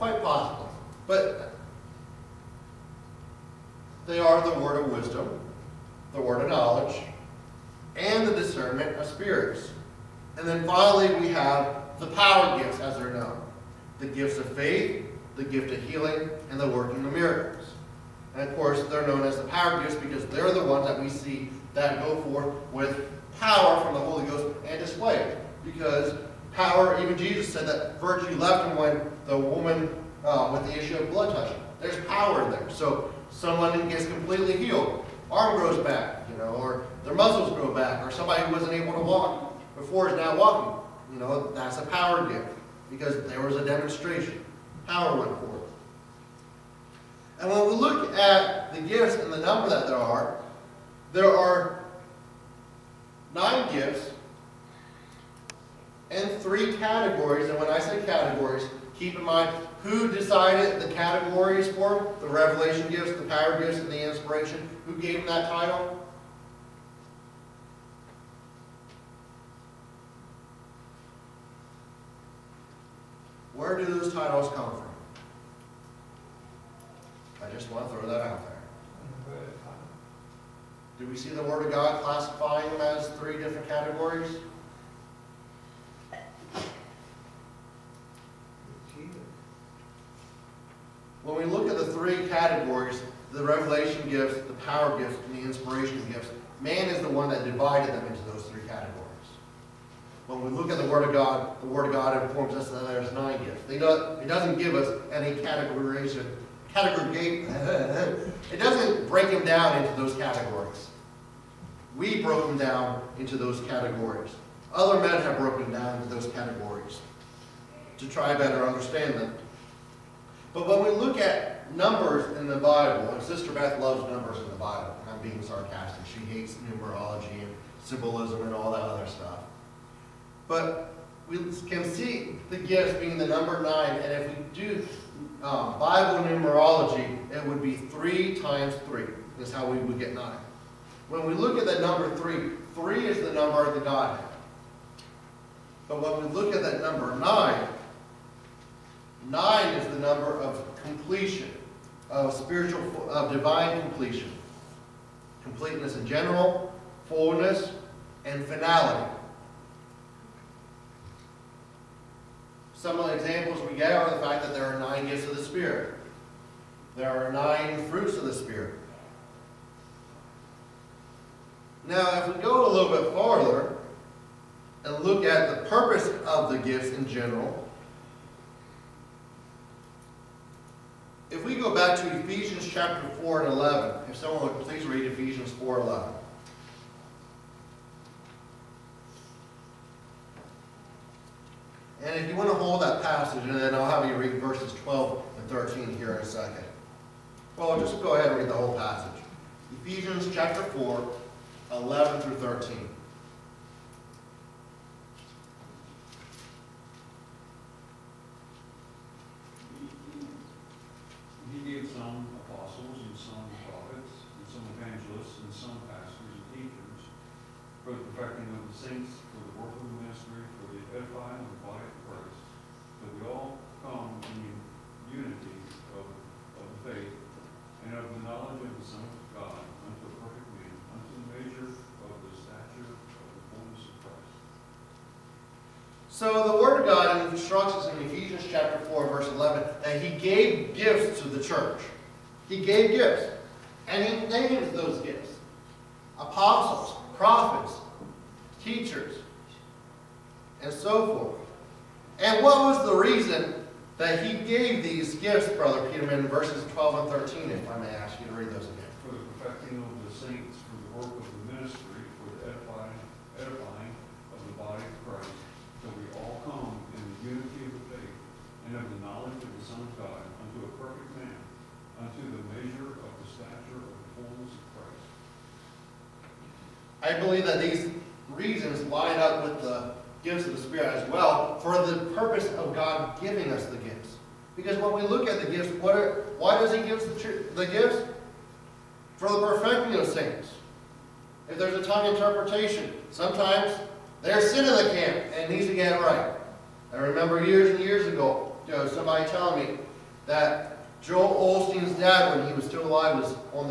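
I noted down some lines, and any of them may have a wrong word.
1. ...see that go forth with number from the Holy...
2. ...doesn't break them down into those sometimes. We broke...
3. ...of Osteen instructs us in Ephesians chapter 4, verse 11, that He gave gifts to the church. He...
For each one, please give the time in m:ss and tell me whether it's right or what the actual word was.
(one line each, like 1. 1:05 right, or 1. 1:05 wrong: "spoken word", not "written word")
1. 0:21 wrong: "power", not "number"
2. 1:48 wrong: "categories", not "sometimes"
3. 3:56 wrong: "God", not "Osteen".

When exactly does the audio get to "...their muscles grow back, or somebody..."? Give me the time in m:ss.
0:37.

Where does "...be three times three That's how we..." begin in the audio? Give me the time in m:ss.
2:17.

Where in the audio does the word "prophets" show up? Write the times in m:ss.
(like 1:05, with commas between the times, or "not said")
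3:33, 4:07.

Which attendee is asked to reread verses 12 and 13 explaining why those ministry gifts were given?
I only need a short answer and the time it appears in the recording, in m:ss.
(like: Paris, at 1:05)
Brother Peterman, at 4:15.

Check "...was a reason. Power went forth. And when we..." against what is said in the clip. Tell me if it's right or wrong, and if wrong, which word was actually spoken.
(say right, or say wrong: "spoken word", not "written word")
wrong: "demonstration", not "reason".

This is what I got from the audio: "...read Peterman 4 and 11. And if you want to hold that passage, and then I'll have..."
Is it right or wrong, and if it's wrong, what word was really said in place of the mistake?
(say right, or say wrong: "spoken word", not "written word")
wrong: "Ephesians", not "Peterman".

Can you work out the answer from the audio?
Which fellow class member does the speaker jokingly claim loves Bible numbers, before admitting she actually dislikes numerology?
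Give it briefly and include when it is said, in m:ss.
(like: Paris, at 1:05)
Sister Beth, at 2:03.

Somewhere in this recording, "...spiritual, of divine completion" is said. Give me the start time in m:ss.
2:32.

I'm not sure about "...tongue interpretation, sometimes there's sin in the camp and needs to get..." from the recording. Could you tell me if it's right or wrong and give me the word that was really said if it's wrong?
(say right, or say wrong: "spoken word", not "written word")
right.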